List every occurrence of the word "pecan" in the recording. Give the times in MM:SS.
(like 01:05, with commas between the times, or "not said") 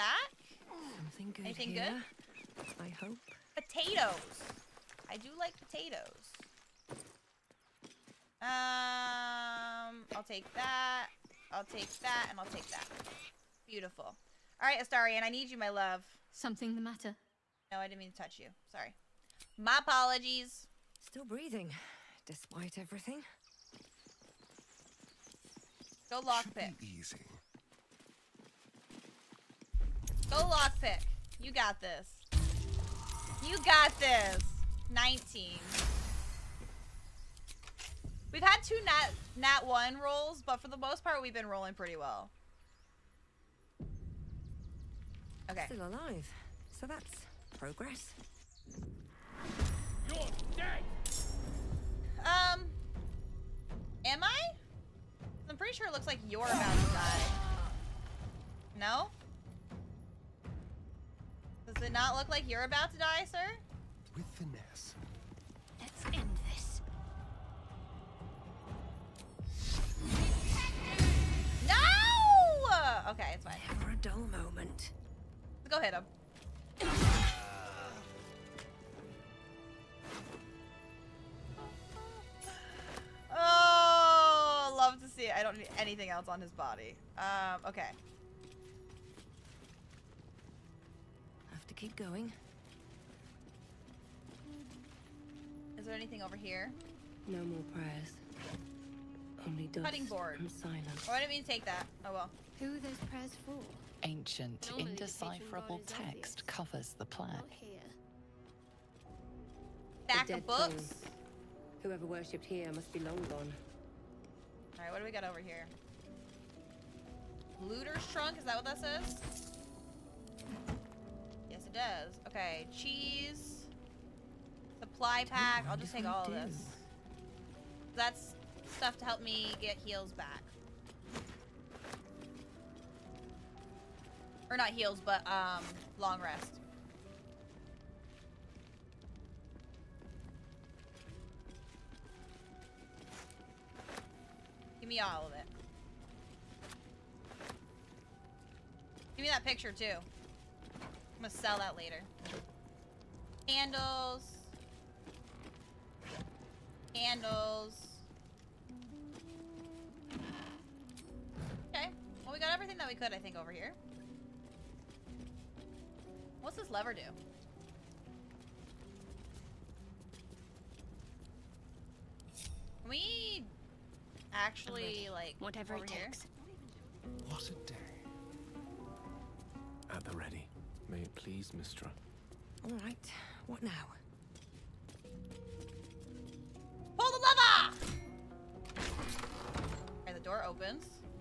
not said.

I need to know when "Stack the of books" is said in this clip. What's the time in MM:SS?
01:50.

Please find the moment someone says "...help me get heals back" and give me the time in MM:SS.
02:09.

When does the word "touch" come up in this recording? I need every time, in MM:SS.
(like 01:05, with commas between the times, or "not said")
00:18.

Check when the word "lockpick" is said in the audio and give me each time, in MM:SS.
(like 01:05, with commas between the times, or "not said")
00:26, 00:30.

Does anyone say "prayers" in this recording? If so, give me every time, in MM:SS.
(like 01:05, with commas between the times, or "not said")
01:37, 01:43.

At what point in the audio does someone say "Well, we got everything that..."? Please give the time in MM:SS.
02:42.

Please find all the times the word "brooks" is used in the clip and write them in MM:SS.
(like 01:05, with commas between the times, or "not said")
not said.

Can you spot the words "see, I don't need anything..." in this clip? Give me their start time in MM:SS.
01:25.